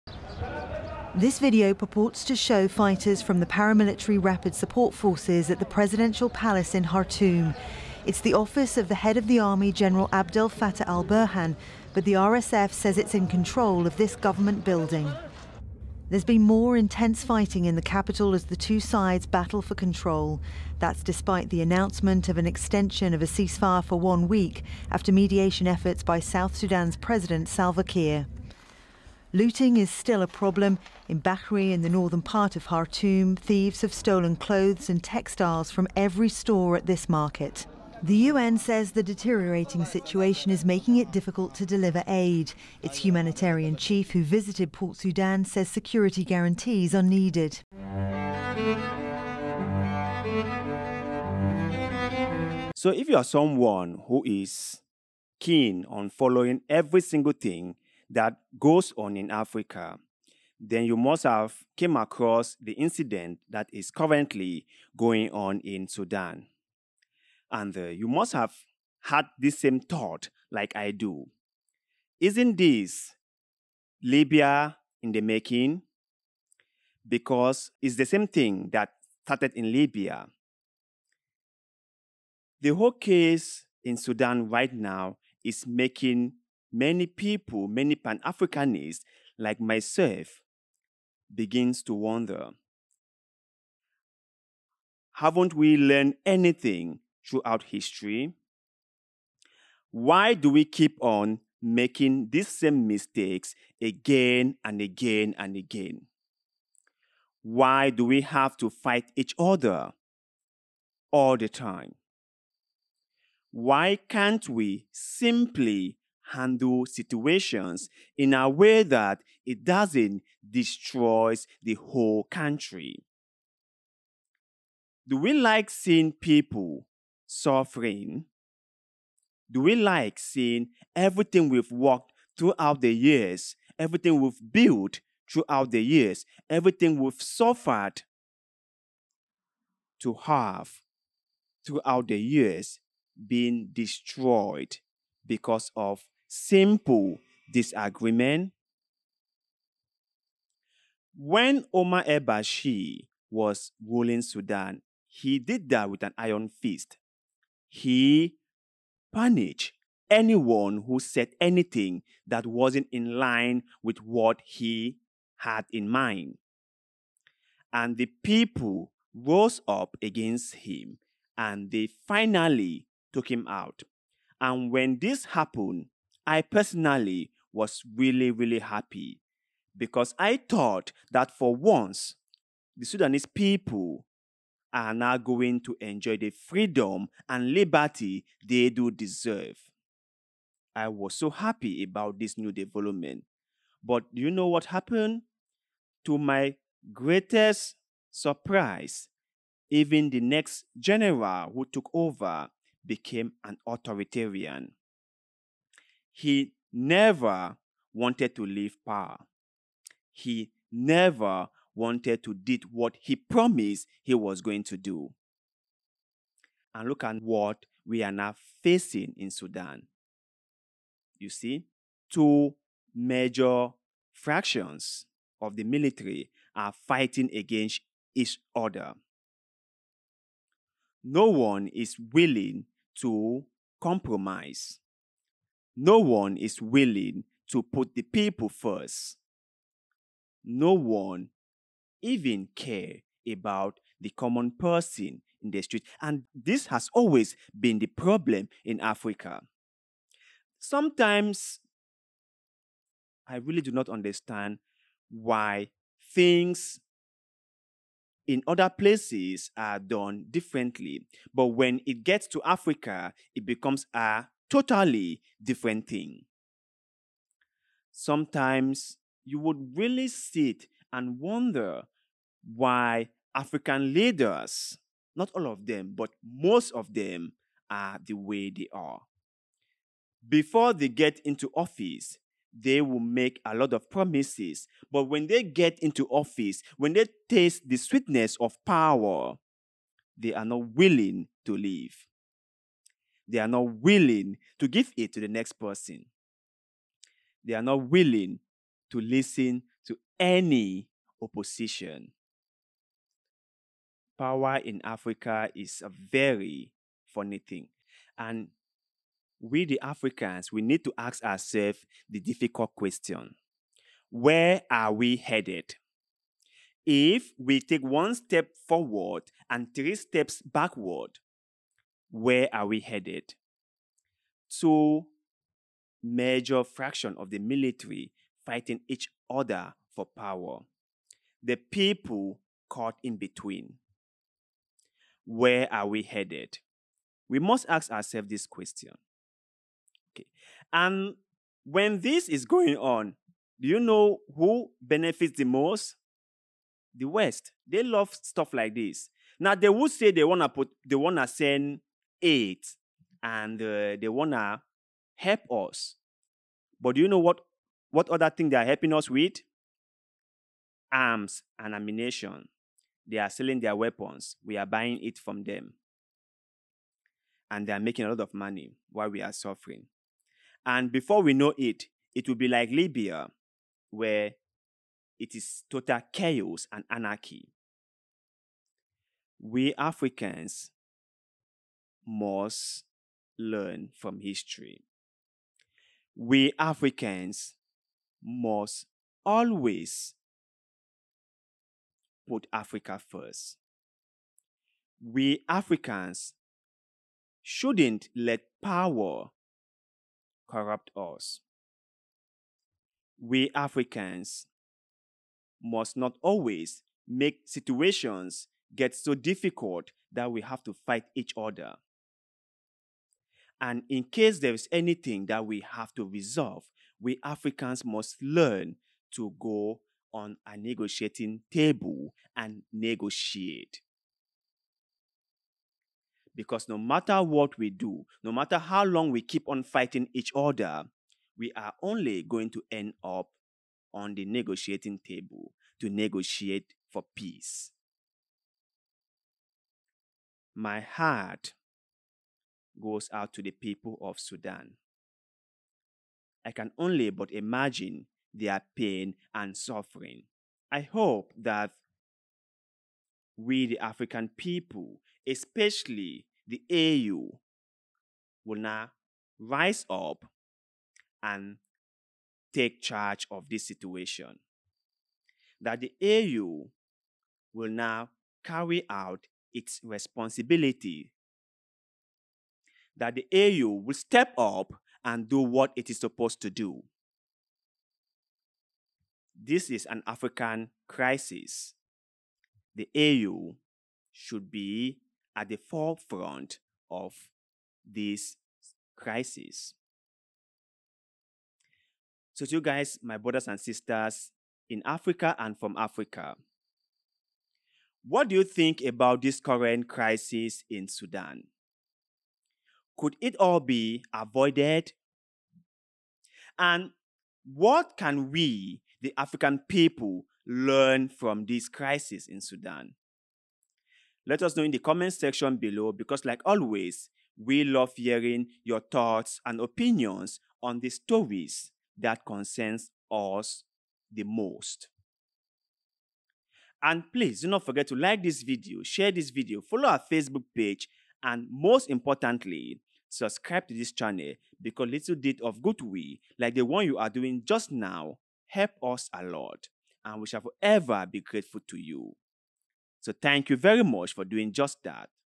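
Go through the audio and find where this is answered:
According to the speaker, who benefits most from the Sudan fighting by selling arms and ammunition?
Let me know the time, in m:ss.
5:46.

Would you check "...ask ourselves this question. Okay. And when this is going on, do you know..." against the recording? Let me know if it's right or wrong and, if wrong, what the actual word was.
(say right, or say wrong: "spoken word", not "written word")
right.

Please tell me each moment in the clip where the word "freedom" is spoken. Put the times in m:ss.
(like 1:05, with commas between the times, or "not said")
3:06.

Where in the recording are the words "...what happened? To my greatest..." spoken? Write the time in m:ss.
3:14.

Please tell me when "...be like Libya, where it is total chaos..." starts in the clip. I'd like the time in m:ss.
6:12.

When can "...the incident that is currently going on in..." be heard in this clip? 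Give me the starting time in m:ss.
1:02.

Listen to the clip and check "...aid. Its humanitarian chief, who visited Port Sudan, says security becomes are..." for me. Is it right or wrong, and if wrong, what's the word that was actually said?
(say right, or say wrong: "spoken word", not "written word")
wrong: "guarantees", not "becomes".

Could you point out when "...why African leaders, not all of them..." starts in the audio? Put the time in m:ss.
4:32.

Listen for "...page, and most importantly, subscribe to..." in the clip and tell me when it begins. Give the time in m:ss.
8:50.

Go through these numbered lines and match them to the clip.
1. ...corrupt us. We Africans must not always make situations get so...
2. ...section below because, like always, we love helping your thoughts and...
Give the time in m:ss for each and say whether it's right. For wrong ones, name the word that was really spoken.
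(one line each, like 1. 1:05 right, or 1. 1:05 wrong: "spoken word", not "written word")
1. 6:40 right
2. 8:35 wrong: "hearing", not "helping".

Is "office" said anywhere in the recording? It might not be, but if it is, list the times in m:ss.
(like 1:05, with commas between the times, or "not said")
0:08, 4:41, 4:46.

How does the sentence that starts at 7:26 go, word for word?
I can only but imagine their pain and suffering.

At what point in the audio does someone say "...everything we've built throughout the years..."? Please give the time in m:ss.
2:13.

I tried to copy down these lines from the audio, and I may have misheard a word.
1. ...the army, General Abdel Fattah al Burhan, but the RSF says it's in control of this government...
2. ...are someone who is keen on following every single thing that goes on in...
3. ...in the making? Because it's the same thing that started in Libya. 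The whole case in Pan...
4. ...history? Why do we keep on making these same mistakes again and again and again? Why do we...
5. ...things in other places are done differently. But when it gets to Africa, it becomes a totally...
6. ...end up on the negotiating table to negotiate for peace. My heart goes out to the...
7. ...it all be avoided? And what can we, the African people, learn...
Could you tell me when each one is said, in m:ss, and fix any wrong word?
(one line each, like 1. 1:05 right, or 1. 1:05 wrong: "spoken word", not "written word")
1. 0:09 right
2. 0:53 right
3. 1:15 wrong: "Sudan", not "Pan"
4. 1:37 right
5. 4:16 right
6. 7:12 right
7. 8:23 right.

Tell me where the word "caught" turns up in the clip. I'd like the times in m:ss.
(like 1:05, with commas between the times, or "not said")
5:32.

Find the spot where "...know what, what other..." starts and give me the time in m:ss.
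5:57.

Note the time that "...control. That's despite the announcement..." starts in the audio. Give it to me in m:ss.
0:19.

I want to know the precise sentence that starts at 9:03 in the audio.
So thank you very much for doing just that.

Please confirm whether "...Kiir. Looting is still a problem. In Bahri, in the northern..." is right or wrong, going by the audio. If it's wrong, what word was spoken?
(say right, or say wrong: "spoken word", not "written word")
right.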